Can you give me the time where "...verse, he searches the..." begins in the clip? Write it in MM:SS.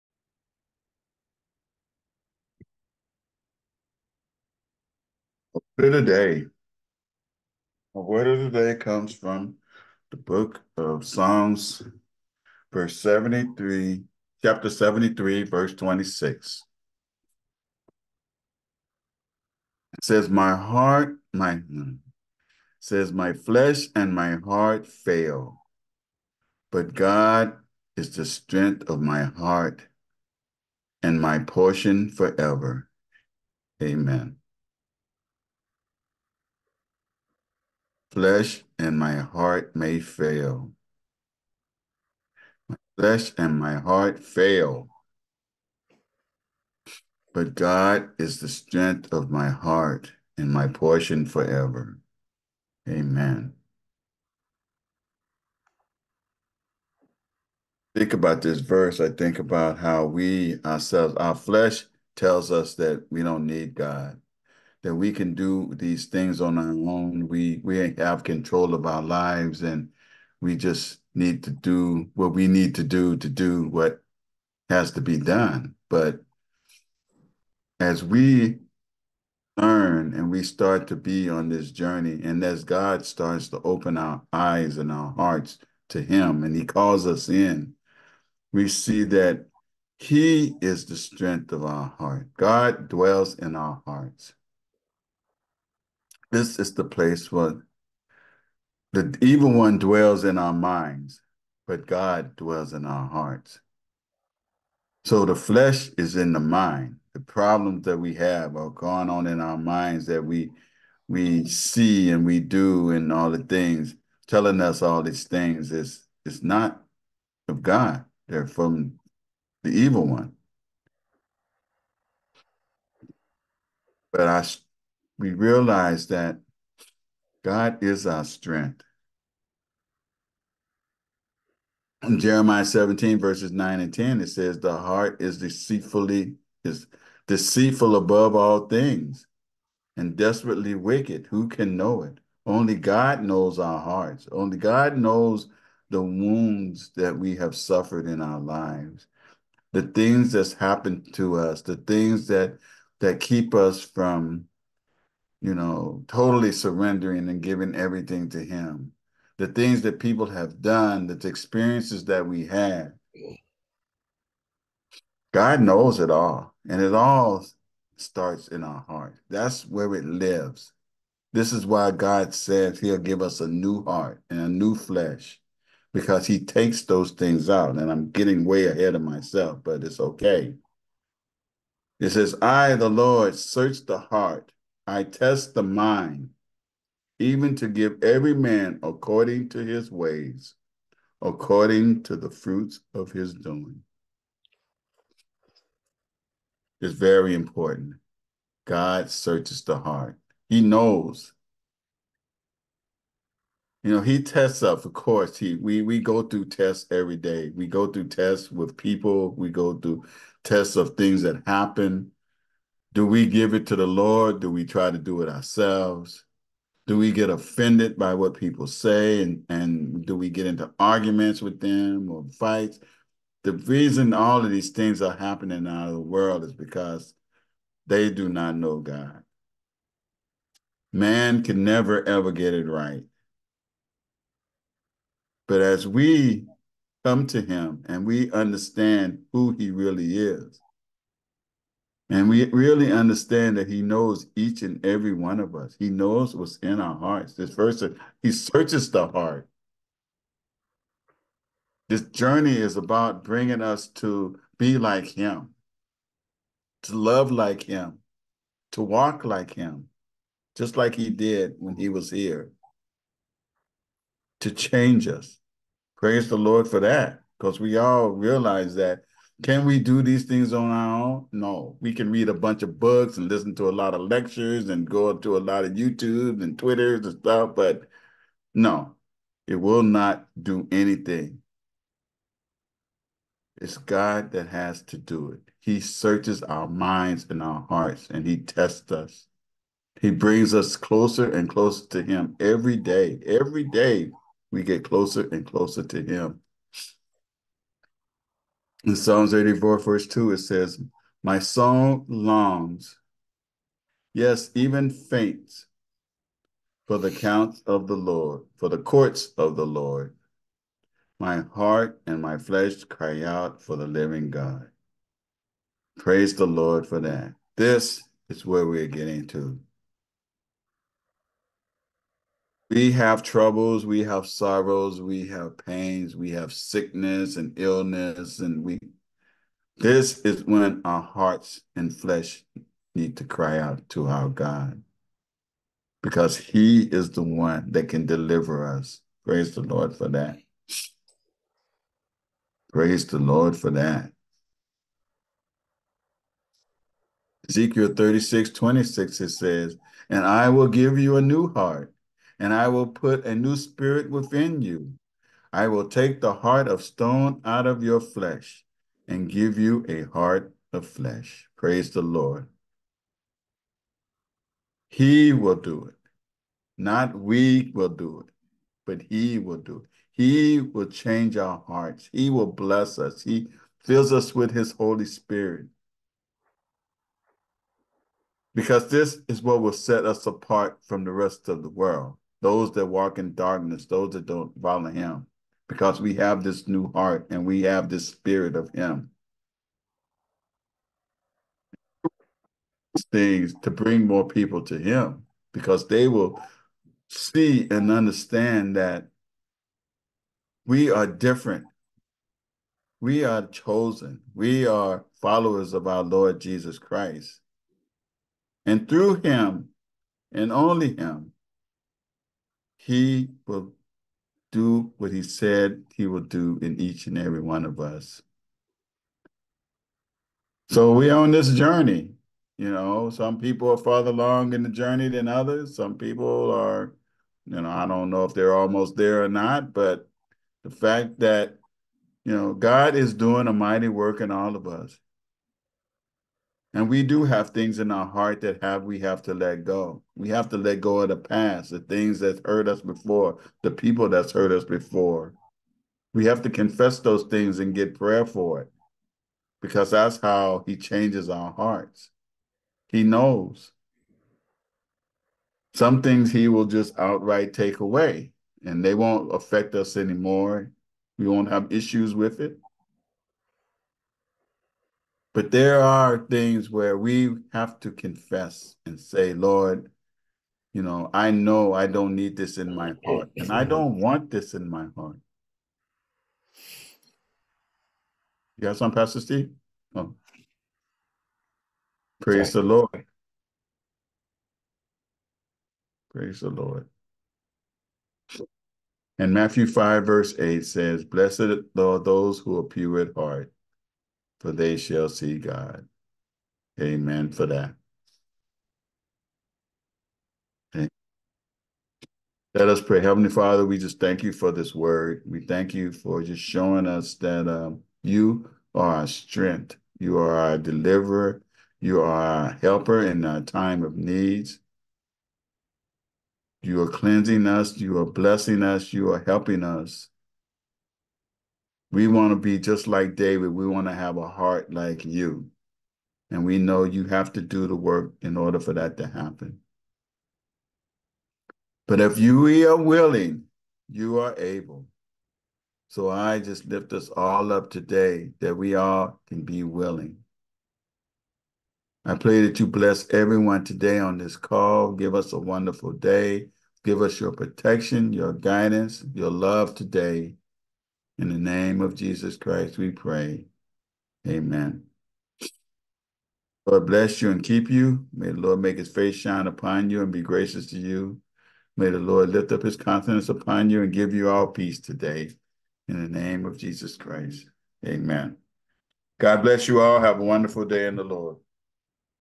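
04:07.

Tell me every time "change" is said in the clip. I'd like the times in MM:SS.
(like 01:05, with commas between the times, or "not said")
04:24, 06:10, 07:30.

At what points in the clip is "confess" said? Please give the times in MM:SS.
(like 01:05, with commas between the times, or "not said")
07:26, 07:47.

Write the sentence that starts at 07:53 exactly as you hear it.
don't want this in my heart.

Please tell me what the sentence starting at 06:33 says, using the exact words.
Things to bring more people to him because they will see and understand that we are different.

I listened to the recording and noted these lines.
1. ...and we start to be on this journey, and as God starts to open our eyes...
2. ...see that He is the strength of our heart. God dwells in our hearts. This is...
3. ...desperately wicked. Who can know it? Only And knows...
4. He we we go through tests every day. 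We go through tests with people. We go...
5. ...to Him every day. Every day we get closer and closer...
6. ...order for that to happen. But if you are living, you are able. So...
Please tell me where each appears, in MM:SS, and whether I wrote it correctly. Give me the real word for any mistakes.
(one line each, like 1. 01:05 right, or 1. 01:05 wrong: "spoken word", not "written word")
1. 01:20 right
2. 01:28 right
3. 02:20 wrong: "God", not "And"
4. 03:25 right
5. 04:51 right
6. 08:48 wrong: "willing", not "living".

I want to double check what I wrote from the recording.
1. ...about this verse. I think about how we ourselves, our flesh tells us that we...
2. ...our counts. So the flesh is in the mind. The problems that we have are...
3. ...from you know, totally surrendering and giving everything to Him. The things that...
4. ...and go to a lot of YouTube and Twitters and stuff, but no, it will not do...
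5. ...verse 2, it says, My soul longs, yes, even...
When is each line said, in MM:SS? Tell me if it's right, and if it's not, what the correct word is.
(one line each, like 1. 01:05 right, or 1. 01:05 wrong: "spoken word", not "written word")
1. 00:58 right
2. 01:42 wrong: "hearts", not "counts"
3. 02:33 right
4. 04:34 right
5. 04:59 right.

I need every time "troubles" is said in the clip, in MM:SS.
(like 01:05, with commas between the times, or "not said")
05:23.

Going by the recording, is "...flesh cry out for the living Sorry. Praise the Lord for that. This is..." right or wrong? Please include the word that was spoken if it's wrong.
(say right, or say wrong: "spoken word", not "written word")
wrong: "God", not "Sorry".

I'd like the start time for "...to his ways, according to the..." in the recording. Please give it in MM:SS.
03:09.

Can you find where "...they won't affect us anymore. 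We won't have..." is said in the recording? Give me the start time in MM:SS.
07:38.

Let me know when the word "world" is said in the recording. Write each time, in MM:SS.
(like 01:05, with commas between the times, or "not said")
03:46, 06:21.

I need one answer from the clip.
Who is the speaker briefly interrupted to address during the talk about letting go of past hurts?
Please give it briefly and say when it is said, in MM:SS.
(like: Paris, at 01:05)
Pastor Steve, at 07:58.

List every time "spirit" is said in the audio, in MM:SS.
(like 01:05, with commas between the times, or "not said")
05:53, 06:15, 06:28.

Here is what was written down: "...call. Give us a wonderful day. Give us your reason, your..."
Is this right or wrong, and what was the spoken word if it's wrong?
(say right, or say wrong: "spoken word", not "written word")
wrong: "protection", not "reason".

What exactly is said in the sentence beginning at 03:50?
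Man can never ever get it right.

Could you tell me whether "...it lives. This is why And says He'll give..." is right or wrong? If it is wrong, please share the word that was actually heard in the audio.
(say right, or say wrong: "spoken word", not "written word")
wrong: "God", not "And".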